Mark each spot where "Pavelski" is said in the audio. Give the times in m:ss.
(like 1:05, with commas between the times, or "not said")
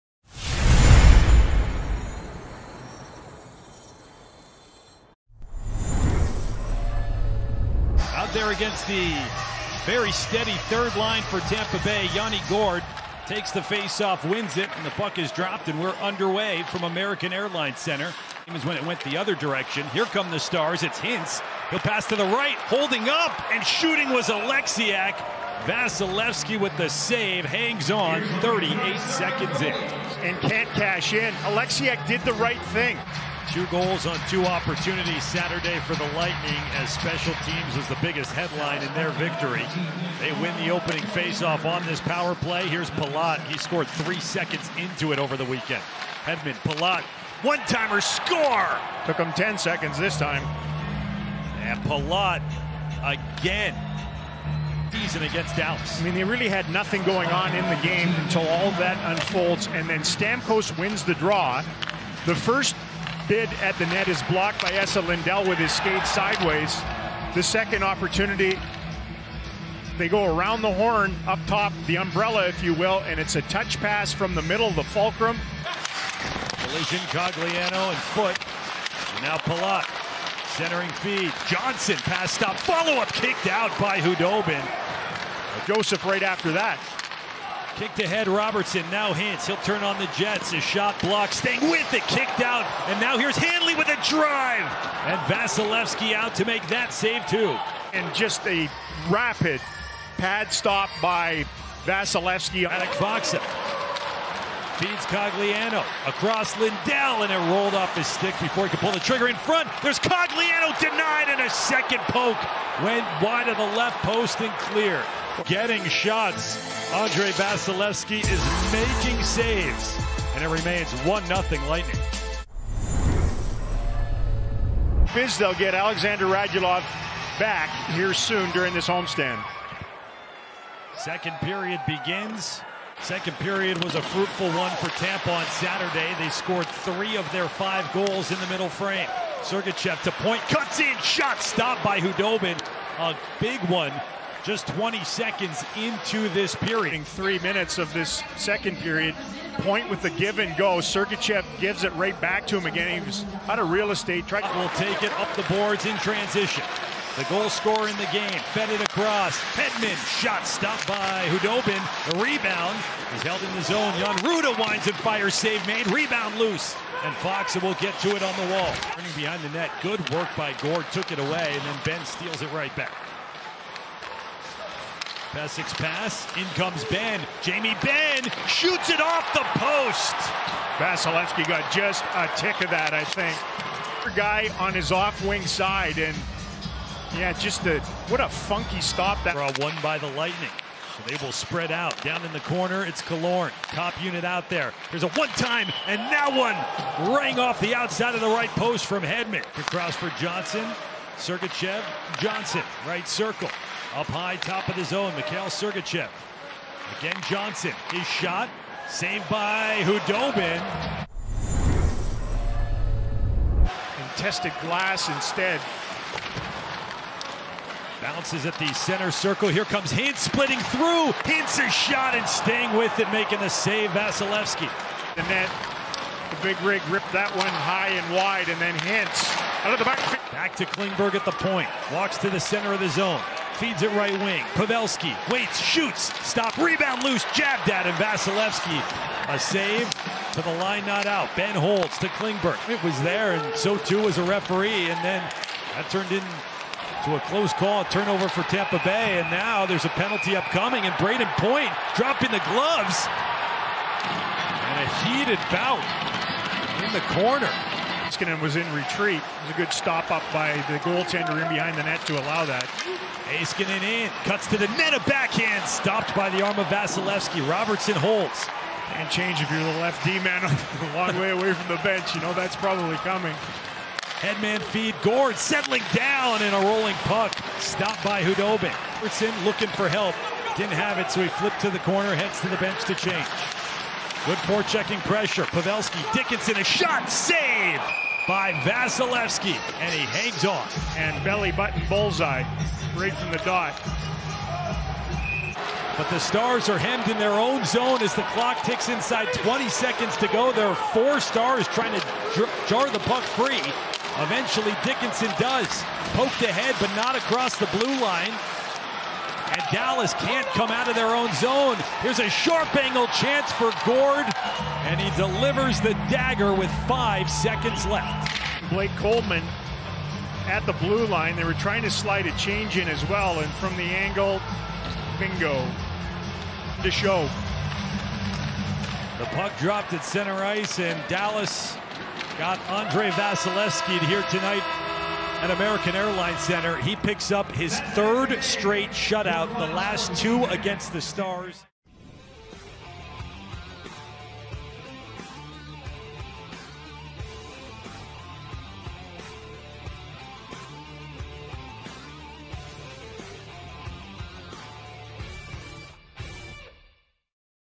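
3:54, 4:45.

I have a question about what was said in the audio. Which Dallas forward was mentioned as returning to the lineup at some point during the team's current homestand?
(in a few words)
Alexander Radulov.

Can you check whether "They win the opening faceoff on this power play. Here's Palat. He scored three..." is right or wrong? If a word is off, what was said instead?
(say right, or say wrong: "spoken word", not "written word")
right.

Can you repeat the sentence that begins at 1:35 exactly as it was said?
And Vasilevskiy out to make that save, too.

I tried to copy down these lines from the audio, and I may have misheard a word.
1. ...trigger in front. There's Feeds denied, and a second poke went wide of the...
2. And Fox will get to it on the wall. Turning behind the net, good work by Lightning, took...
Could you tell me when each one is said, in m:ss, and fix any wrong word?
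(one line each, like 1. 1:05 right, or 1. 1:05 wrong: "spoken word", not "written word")
1. 1:48 wrong: "Cogliano", not "Feeds"
2. 2:47 wrong: "Gourde", not "Lightning".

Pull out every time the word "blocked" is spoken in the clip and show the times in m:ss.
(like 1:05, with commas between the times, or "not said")
1:04, 1:31.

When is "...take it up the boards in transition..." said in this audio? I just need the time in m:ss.
2:34.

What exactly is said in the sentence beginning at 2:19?
Sergachev to point, cuts in, shot stopped by Khudobin.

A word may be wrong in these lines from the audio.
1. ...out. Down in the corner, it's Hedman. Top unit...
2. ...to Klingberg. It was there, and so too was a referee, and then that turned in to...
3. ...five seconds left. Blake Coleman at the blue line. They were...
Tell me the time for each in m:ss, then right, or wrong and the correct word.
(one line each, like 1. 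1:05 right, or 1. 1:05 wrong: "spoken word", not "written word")
1. 3:11 wrong: "Killorn", not "Hedman"
2. 4:01 right
3. 5:16 right.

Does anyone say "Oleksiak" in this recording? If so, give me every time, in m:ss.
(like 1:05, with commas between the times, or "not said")
0:24, 0:31.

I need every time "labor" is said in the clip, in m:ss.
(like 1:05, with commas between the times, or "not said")
not said.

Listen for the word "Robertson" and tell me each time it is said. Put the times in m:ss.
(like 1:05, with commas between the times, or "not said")
1:28, 4:27, 4:38.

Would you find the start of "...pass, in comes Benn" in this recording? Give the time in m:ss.
2:55.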